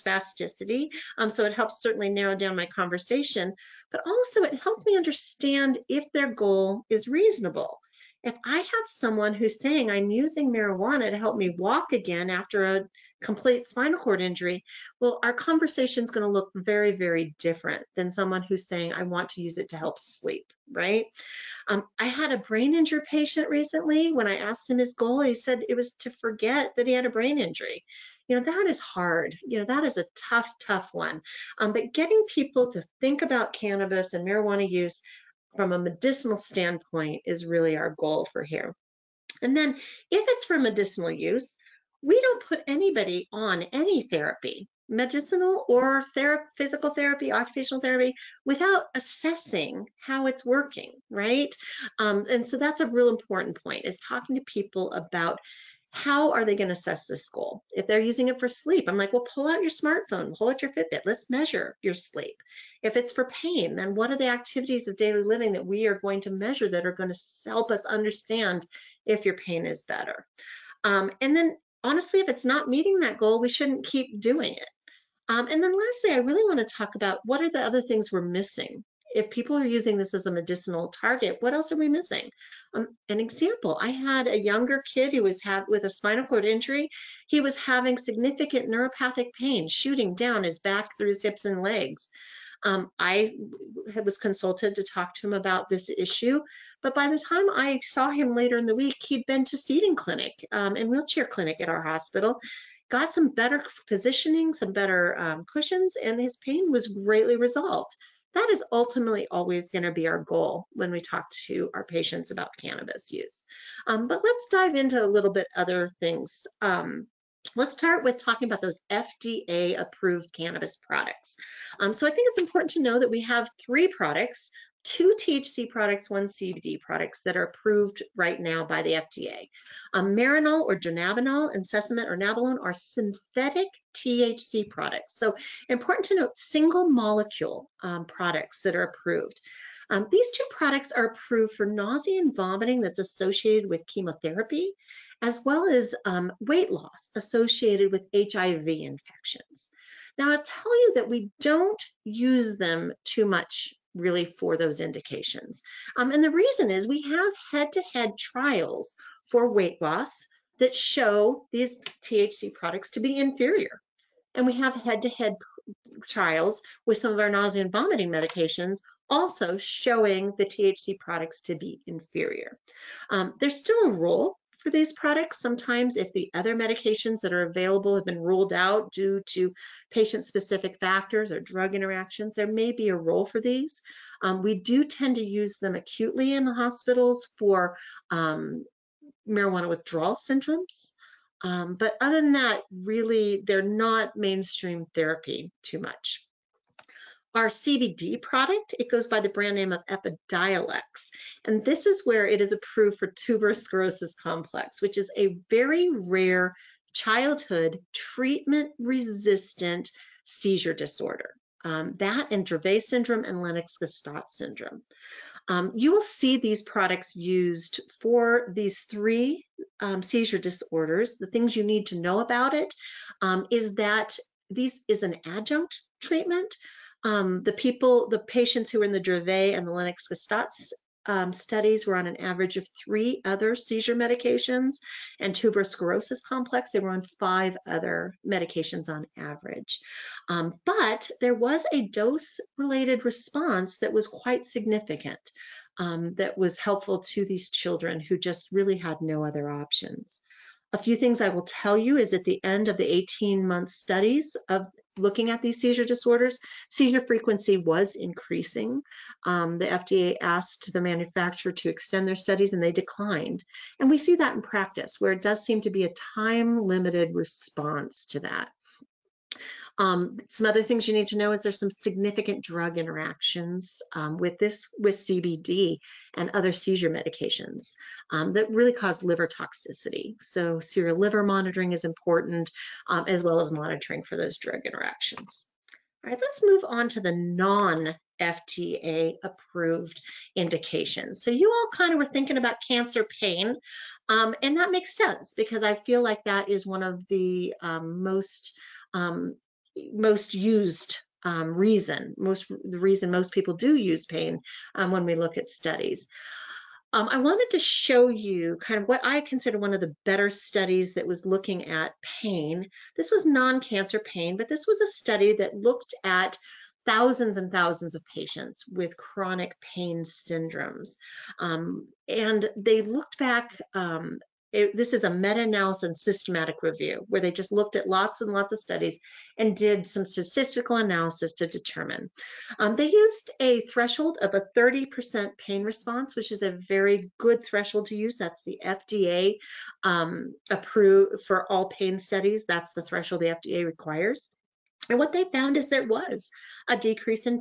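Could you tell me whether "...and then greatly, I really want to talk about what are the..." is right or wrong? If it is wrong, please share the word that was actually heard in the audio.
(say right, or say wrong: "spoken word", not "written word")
wrong: "lastly", not "greatly".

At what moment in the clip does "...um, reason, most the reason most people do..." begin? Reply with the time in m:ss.
5:01.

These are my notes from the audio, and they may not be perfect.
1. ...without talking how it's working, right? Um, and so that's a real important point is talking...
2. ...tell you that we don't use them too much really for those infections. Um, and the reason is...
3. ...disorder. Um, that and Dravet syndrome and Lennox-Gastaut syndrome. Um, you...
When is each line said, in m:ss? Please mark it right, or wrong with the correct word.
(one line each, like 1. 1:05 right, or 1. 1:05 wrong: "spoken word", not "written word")
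1. 0:48 wrong: "assessing", not "talking"
2. 2:30 wrong: "indications", not "infections"
3. 3:30 right.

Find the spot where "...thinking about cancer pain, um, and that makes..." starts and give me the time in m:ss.
4:52.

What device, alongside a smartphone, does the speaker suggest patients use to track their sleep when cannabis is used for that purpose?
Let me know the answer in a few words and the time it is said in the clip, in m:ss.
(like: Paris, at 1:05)
Fitbit, at 1:00.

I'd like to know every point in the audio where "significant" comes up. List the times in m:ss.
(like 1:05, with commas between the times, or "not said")
1:27, 4:04, 4:31.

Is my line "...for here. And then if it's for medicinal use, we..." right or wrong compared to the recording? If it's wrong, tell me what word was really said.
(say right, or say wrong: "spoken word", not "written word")
right.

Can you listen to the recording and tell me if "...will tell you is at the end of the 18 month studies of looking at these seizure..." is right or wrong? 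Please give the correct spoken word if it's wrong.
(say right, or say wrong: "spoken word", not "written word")
right.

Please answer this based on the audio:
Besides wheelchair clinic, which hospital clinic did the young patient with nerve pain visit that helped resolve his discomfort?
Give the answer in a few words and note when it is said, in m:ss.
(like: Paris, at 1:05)
Seating clinic, at 1:39.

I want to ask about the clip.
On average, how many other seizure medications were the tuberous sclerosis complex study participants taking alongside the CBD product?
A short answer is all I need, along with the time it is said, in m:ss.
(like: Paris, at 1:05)
5, at 3:57.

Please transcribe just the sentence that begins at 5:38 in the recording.
That's the FDA um, approved for all pain studies.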